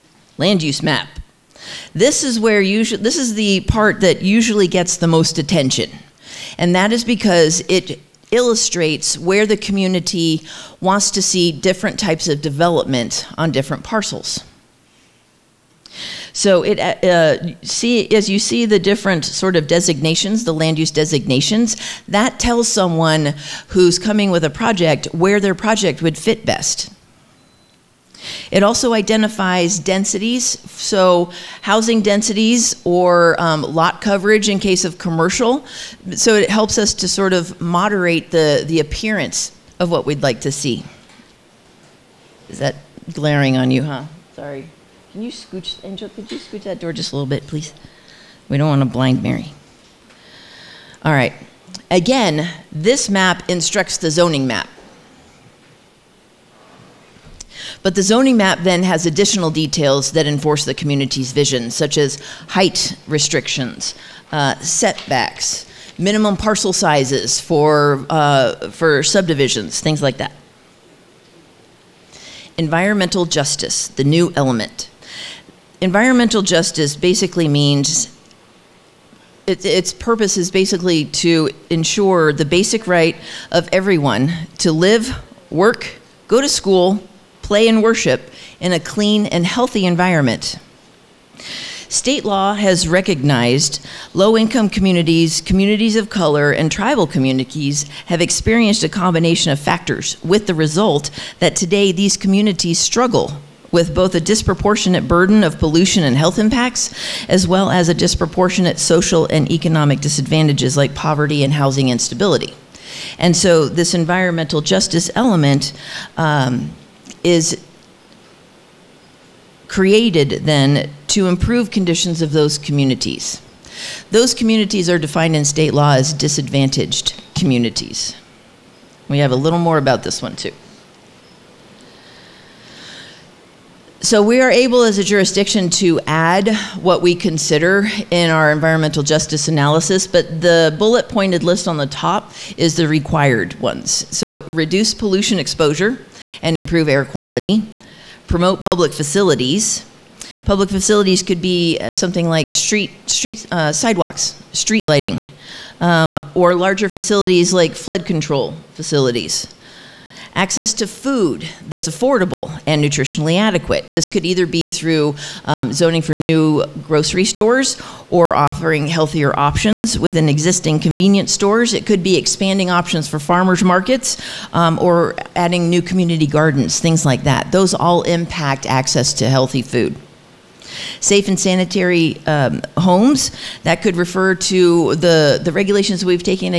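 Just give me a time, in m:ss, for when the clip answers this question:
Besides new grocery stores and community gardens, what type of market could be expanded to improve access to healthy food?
2:53.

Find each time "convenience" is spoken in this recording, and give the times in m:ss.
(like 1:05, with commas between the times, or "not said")
2:50.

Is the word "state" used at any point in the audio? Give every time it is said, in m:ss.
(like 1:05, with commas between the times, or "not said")
1:31, 2:05.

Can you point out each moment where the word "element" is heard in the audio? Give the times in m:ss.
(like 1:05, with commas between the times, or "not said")
1:14, 1:55.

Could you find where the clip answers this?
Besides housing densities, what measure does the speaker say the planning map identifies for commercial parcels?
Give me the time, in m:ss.
0:33.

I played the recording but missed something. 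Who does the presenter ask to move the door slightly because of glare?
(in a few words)
Angel.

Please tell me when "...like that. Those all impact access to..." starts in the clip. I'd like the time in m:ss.
2:57.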